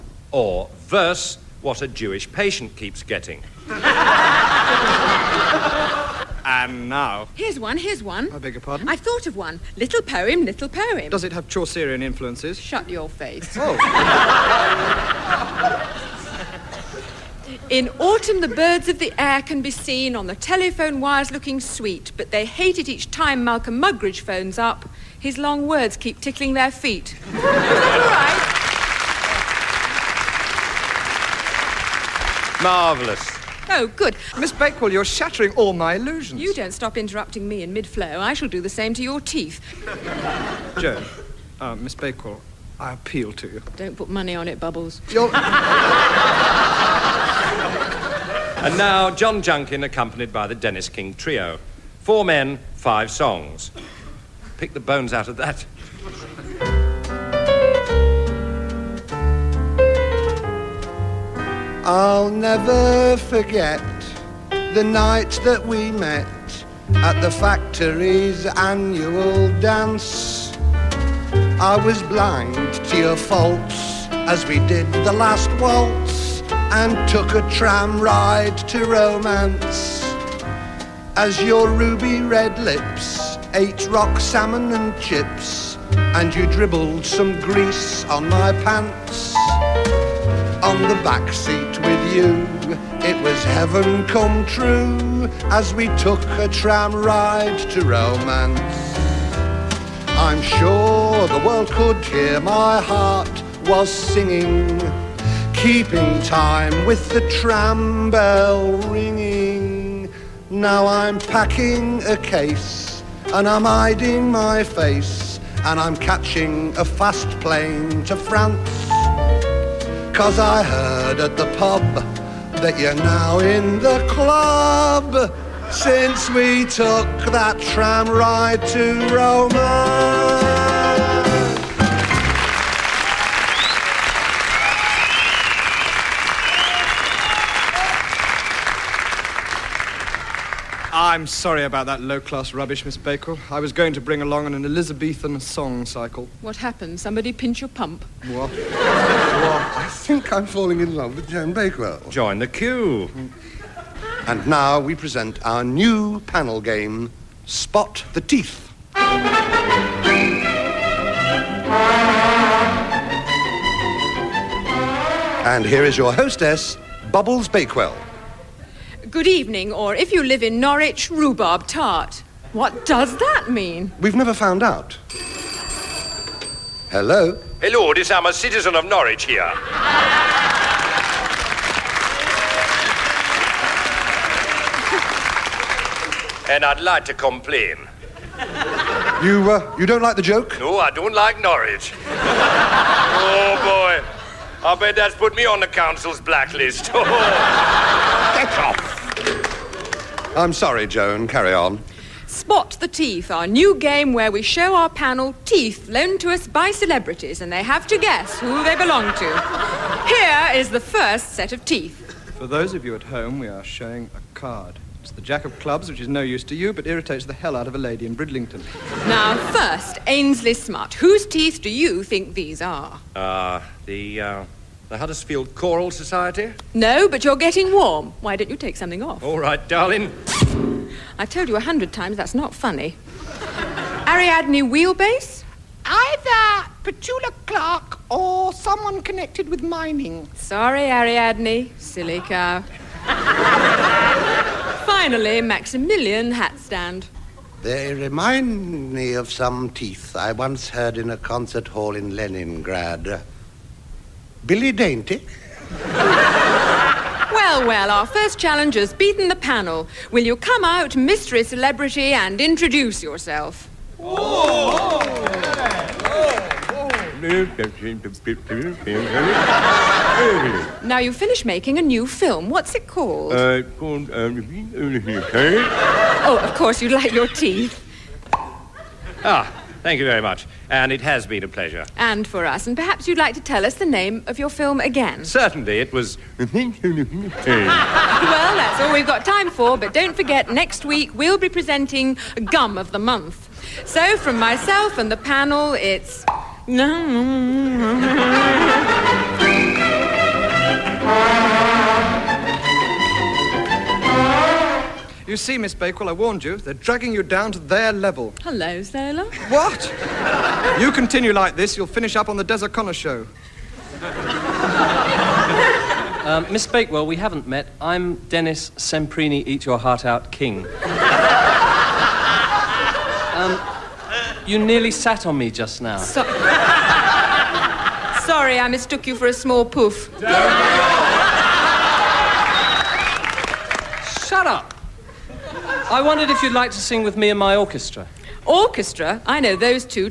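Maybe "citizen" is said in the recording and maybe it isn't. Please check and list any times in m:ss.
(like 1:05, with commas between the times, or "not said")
2:58.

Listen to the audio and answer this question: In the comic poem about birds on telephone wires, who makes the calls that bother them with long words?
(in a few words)
Malcolm Muggeridge.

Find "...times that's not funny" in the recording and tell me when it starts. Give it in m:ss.
3:51.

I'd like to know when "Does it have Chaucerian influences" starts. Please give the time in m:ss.
0:11.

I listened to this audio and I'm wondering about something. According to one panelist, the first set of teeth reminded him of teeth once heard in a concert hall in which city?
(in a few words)
Leningrad.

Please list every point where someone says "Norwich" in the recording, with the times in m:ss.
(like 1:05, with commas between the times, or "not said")
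2:50, 2:58, 3:11.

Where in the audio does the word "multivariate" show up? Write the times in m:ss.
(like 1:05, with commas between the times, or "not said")
not said.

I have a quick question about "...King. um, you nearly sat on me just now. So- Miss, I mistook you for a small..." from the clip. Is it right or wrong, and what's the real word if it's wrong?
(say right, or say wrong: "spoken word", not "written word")
wrong: "Sorry", not "Miss".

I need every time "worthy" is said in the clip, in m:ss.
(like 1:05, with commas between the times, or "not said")
not said.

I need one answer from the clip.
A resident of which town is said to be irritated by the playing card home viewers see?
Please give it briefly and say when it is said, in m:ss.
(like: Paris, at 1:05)
Bridlington, at 3:38.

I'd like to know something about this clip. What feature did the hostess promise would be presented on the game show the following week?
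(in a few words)
Gum of the Month.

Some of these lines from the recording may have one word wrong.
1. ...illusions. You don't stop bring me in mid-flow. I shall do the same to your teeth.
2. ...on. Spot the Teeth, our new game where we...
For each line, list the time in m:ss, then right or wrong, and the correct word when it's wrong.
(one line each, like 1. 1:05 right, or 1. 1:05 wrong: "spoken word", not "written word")
1. 0:35 wrong: "interrupting", not "bring"
2. 3:21 right.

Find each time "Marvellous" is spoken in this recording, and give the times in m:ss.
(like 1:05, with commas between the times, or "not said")
0:32.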